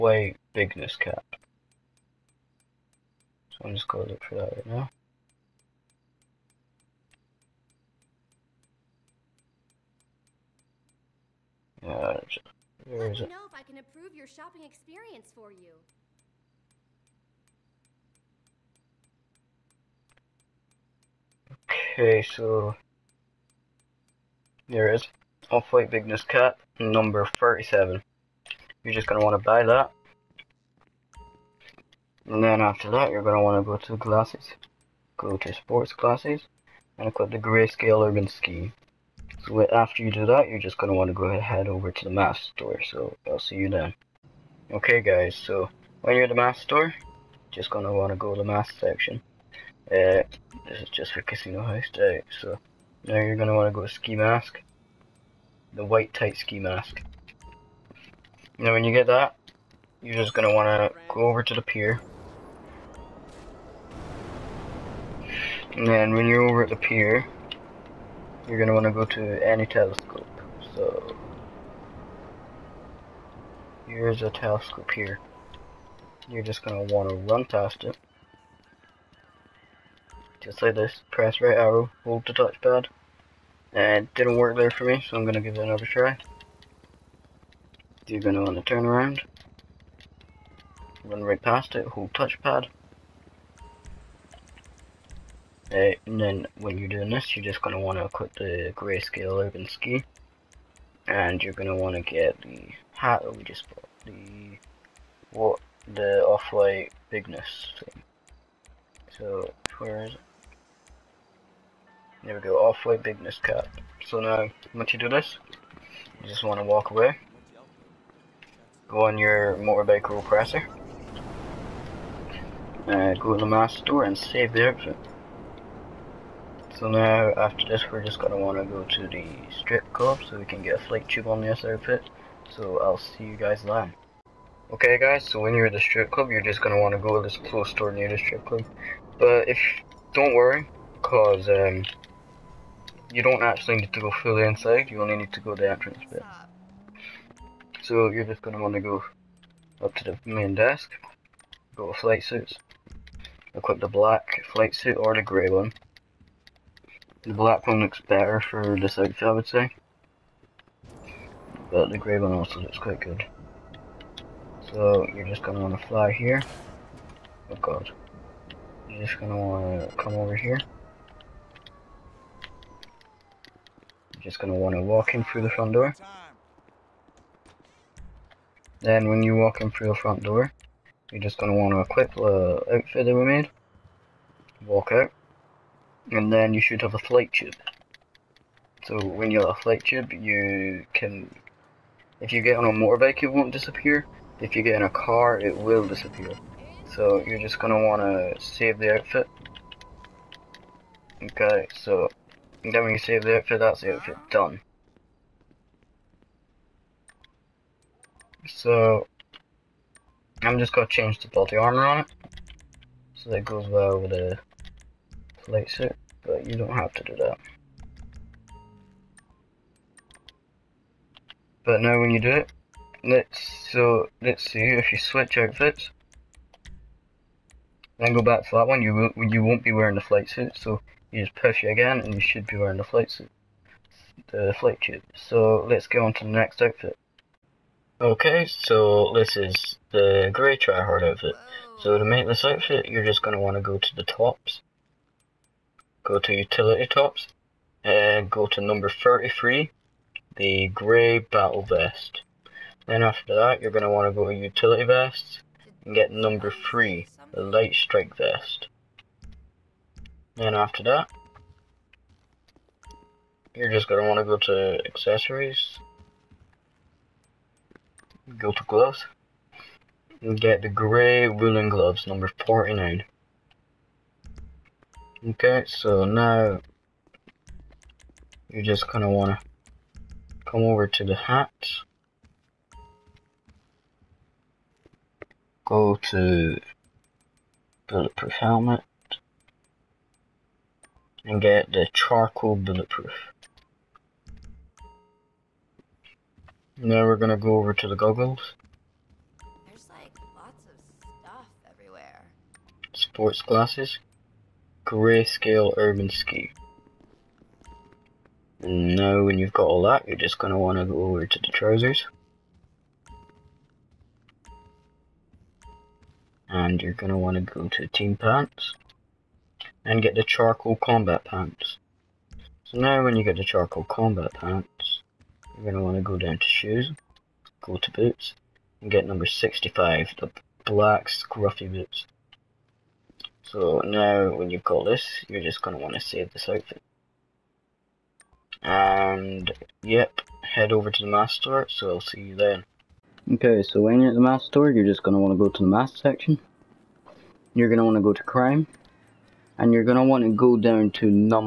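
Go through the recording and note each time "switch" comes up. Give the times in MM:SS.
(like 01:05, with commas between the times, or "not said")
03:44.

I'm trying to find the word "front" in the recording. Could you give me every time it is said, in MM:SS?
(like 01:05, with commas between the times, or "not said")
02:55, 02:59.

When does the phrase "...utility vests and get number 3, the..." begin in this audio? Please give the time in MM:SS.
04:14.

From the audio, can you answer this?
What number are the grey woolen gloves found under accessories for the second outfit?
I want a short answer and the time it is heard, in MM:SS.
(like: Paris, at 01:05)
49, at 04:32.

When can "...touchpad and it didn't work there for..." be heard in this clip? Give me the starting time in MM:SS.
01:22.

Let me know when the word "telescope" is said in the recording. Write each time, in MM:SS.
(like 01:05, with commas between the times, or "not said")
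01:09, 01:14.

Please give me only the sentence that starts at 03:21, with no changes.
Okay, so then when you save the outfit, that's the outfit done.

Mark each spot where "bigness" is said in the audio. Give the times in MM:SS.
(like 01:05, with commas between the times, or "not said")
00:00, 00:25, 01:47, 01:53.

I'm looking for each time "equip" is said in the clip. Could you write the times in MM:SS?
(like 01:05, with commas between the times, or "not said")
00:37, 01:38, 02:33, 03:01.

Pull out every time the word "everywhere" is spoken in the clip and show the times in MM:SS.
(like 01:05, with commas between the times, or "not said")
05:01.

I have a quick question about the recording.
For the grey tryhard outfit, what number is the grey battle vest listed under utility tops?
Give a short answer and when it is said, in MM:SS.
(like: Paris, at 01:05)
33, at 04:08.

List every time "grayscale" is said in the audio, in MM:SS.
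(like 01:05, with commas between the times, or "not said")
00:37, 01:38, 05:04.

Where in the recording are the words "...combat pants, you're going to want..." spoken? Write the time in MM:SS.
05:23.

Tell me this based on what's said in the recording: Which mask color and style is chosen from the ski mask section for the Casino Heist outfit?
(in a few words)
White tight ski mask.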